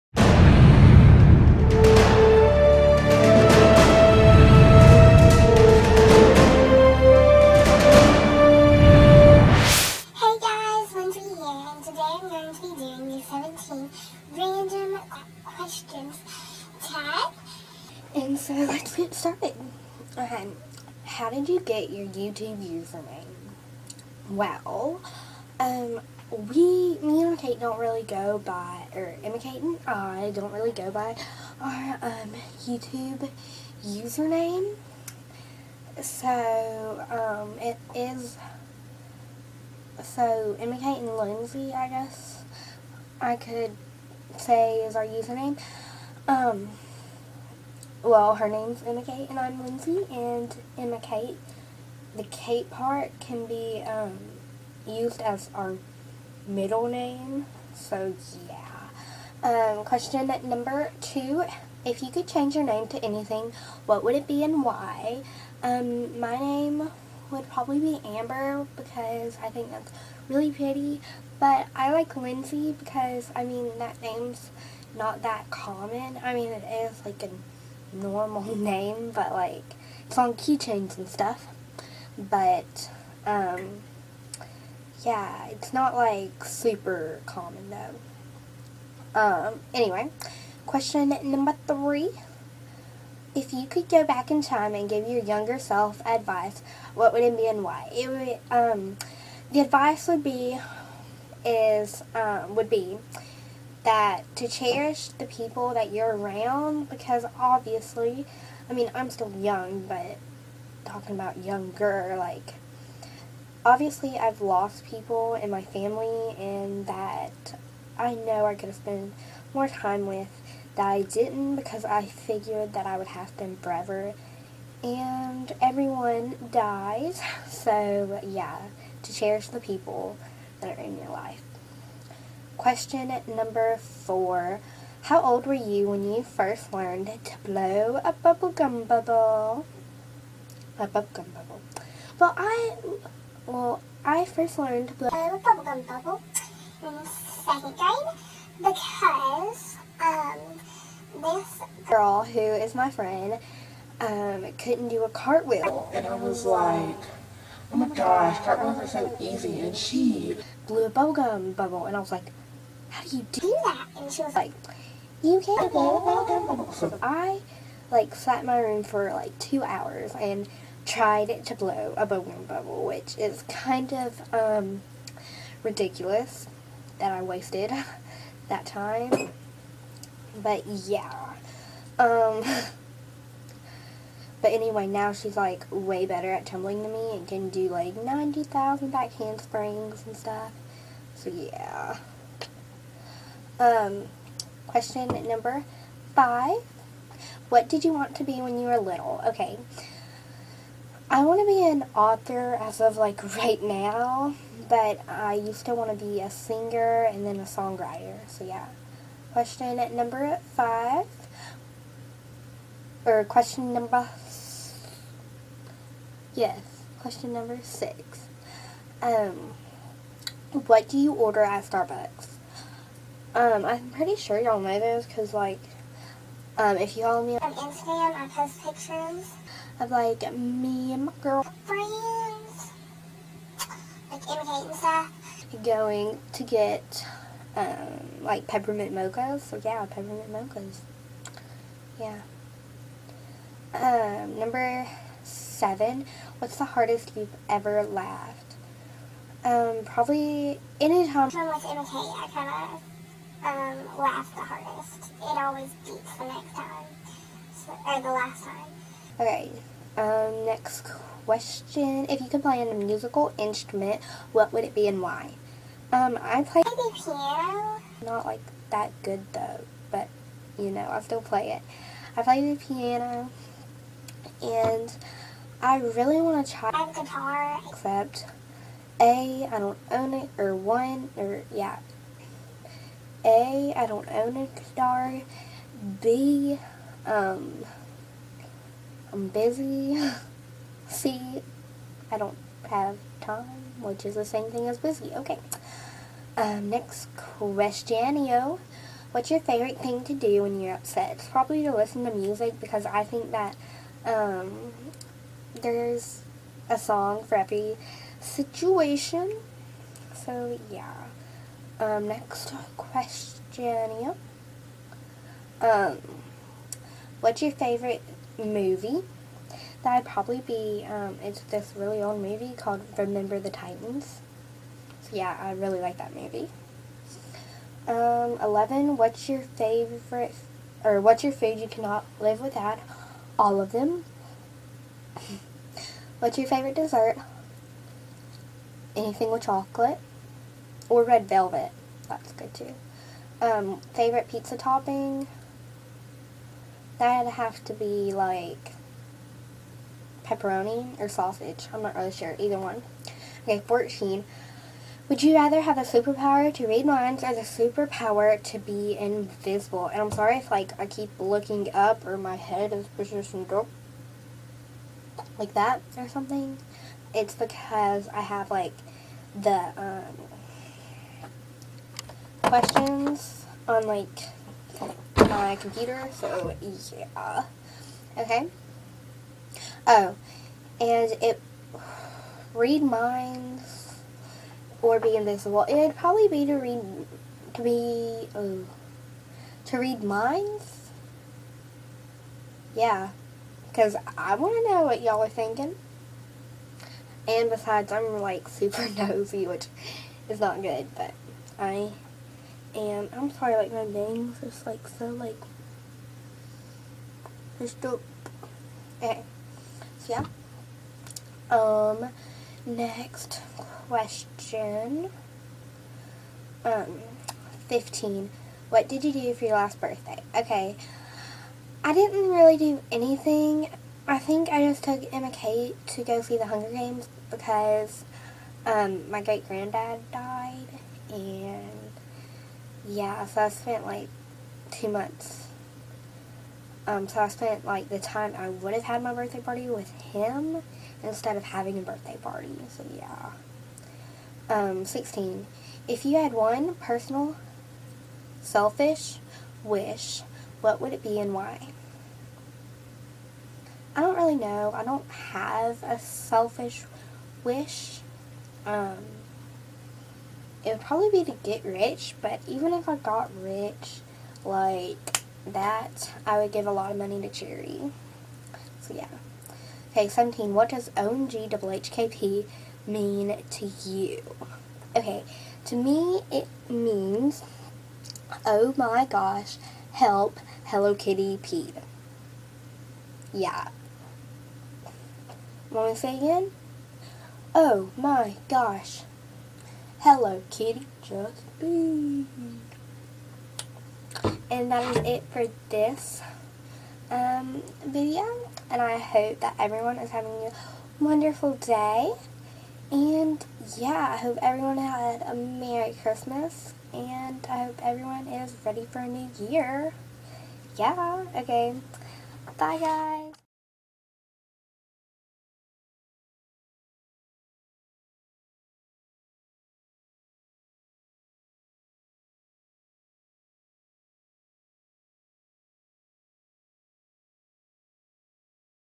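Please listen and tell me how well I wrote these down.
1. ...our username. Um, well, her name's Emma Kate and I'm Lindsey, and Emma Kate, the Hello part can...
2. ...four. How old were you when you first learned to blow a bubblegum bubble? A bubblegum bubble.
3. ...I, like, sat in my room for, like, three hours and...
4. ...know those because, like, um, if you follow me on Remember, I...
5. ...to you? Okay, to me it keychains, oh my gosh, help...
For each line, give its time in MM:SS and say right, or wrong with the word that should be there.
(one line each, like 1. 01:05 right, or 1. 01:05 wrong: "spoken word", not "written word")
1. 00:44 wrong: "Kate", not "Hello"
2. 02:13 right
3. 02:47 wrong: "two", not "three"
4. 03:44 wrong: "Instagram", not "Remember"
5. 07:53 wrong: "means", not "keychains".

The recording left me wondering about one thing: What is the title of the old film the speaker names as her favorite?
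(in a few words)
Remember the Titans.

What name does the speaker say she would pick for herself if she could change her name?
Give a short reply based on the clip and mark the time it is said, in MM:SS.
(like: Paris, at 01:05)
Amber, at 01:08.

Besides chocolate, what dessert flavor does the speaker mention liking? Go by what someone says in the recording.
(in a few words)
Red velvet.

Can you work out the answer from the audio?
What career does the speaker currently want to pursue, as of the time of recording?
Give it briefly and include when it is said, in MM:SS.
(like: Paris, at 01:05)
Author, at 03:21.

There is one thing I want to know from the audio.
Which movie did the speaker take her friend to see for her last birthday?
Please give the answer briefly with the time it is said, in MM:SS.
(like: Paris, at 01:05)
The Hunger Games, at 07:06.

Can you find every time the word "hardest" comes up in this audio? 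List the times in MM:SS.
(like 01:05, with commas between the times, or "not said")
04:06, 04:14.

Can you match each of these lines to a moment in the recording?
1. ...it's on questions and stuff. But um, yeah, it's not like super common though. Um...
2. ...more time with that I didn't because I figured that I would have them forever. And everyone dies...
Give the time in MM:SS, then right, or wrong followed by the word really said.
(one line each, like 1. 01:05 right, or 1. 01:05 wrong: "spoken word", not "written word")
1. 01:20 wrong: "keychains", not "questions"
2. 01:59 right.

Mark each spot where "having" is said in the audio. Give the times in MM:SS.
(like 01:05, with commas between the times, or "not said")
07:21, 08:20.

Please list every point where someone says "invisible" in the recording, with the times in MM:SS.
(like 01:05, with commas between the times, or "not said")
05:58, 06:25.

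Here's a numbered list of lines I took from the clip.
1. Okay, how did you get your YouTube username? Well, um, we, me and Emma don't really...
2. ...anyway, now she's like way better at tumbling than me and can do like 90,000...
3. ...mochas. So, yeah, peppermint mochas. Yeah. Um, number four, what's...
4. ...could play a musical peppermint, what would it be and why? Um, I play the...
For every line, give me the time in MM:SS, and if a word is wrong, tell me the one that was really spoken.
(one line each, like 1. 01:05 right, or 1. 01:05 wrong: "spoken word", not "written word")
1. 00:20 wrong: "Kate", not "Emma"
2. 03:04 right
3. 03:58 wrong: "seven", not "four"
4. 04:22 wrong: "instrument", not "peppermint".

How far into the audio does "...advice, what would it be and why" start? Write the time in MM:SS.
01:36.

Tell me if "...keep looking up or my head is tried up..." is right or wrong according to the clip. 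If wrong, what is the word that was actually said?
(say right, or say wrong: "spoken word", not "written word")
wrong: "positioned", not "tried".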